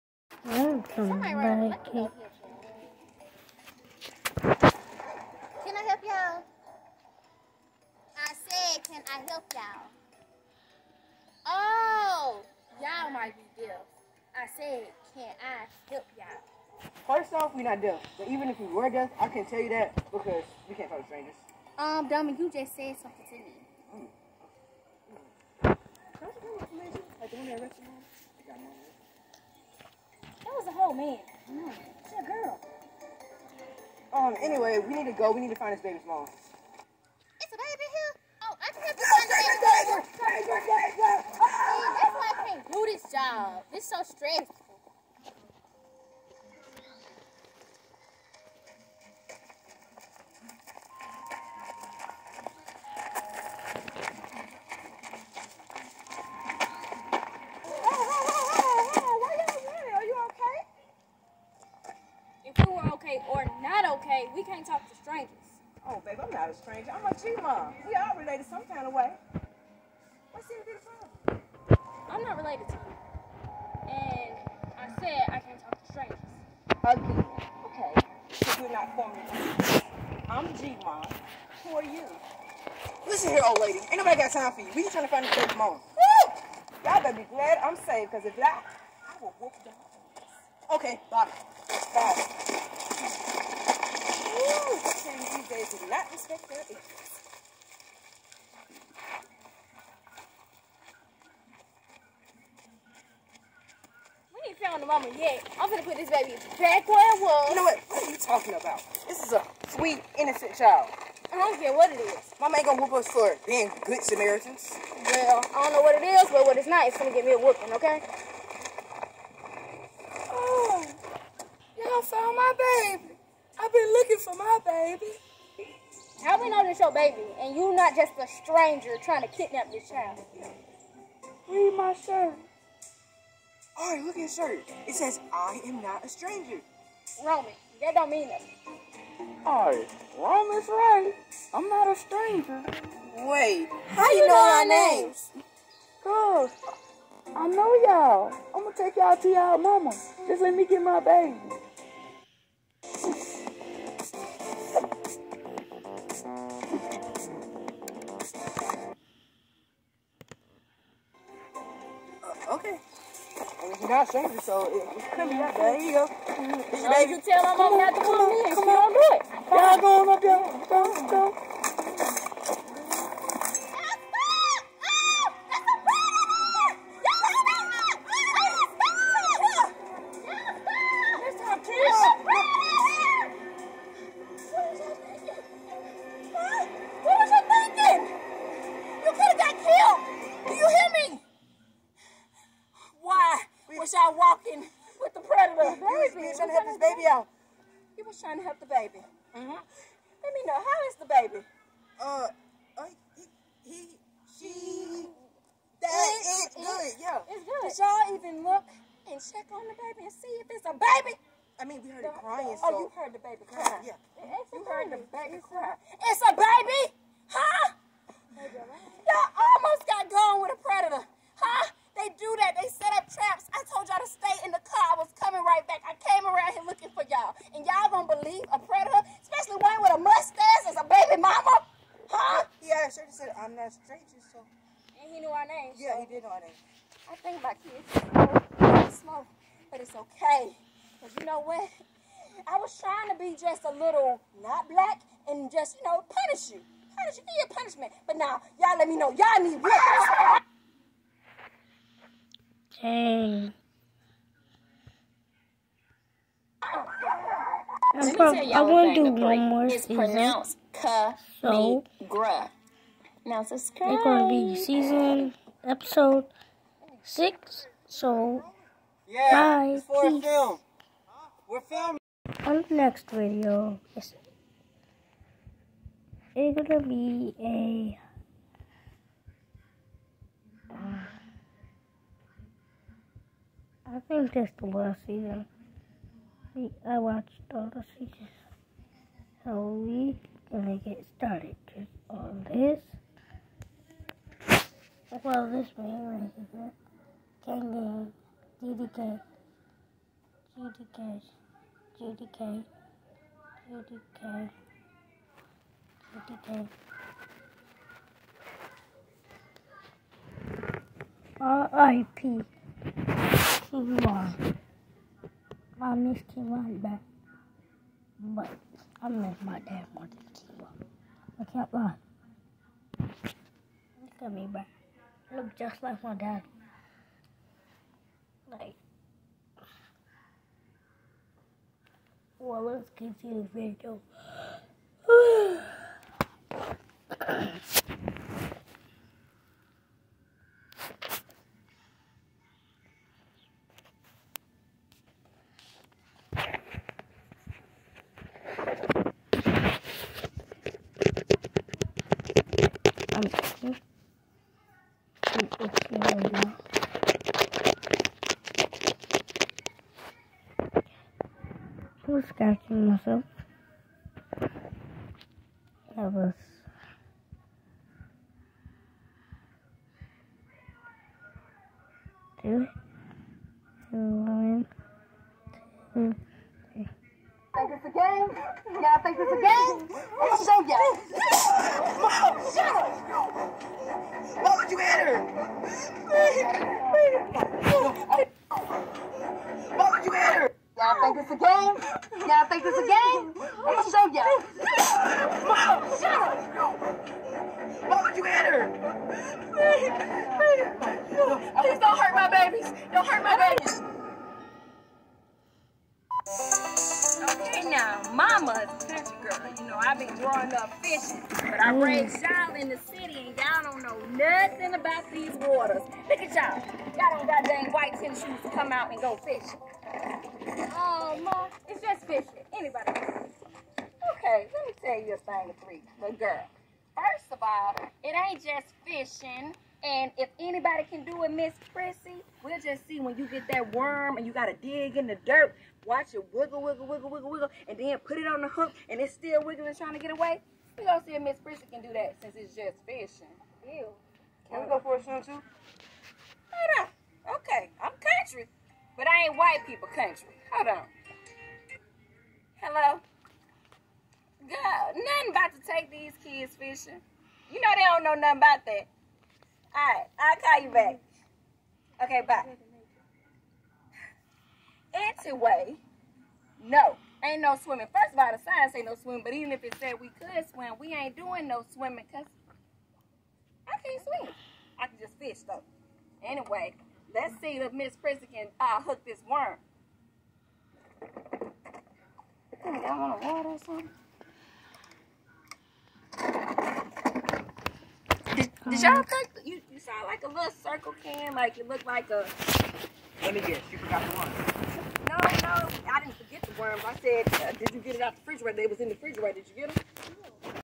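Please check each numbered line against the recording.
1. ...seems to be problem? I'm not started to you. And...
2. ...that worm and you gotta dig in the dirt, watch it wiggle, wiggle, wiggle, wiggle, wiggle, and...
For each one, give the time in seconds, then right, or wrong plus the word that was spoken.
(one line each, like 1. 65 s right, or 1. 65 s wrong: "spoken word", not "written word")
1. 70 s wrong: "related", not "started"
2. 433 s right.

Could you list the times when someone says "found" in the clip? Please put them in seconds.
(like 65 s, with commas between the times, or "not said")
104 s, 122 s.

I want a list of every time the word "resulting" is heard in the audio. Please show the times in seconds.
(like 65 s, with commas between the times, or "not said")
not said.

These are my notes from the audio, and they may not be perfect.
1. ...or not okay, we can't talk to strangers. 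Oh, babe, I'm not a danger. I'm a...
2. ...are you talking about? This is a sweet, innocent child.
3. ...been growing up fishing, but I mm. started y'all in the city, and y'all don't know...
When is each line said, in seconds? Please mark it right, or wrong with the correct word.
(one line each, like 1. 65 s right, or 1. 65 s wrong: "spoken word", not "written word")
1. 63 s wrong: "stranger", not "danger"
2. 108 s right
3. 409 s wrong: "raised", not "started".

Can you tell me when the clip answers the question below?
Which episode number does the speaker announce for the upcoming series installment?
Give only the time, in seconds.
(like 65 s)
265 s.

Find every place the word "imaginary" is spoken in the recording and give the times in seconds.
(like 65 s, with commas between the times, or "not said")
not said.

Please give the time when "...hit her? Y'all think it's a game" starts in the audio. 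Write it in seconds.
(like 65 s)
390 s.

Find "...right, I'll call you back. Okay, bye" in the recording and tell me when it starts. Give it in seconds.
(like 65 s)
459 s.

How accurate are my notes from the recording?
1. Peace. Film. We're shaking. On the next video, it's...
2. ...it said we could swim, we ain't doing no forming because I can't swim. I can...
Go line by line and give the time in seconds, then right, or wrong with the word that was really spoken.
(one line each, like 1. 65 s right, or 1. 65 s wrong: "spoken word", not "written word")
1. 269 s wrong: "filming", not "shaking"
2. 469 s wrong: "swimming", not "forming".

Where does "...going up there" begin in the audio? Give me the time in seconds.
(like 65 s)
169 s.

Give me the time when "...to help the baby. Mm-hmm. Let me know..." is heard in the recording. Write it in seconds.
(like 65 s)
198 s.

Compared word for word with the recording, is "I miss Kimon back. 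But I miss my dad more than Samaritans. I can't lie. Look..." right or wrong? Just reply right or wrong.
wrong.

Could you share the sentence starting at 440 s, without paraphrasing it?
We gonna see if Miss Prissy can do that since it's just fishing.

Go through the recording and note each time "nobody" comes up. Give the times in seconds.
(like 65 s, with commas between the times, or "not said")
83 s.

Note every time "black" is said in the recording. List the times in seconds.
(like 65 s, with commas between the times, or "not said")
244 s.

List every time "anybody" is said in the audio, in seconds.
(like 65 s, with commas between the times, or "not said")
422 s, 430 s.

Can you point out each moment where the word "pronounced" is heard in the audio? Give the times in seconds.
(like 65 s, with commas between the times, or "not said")
259 s.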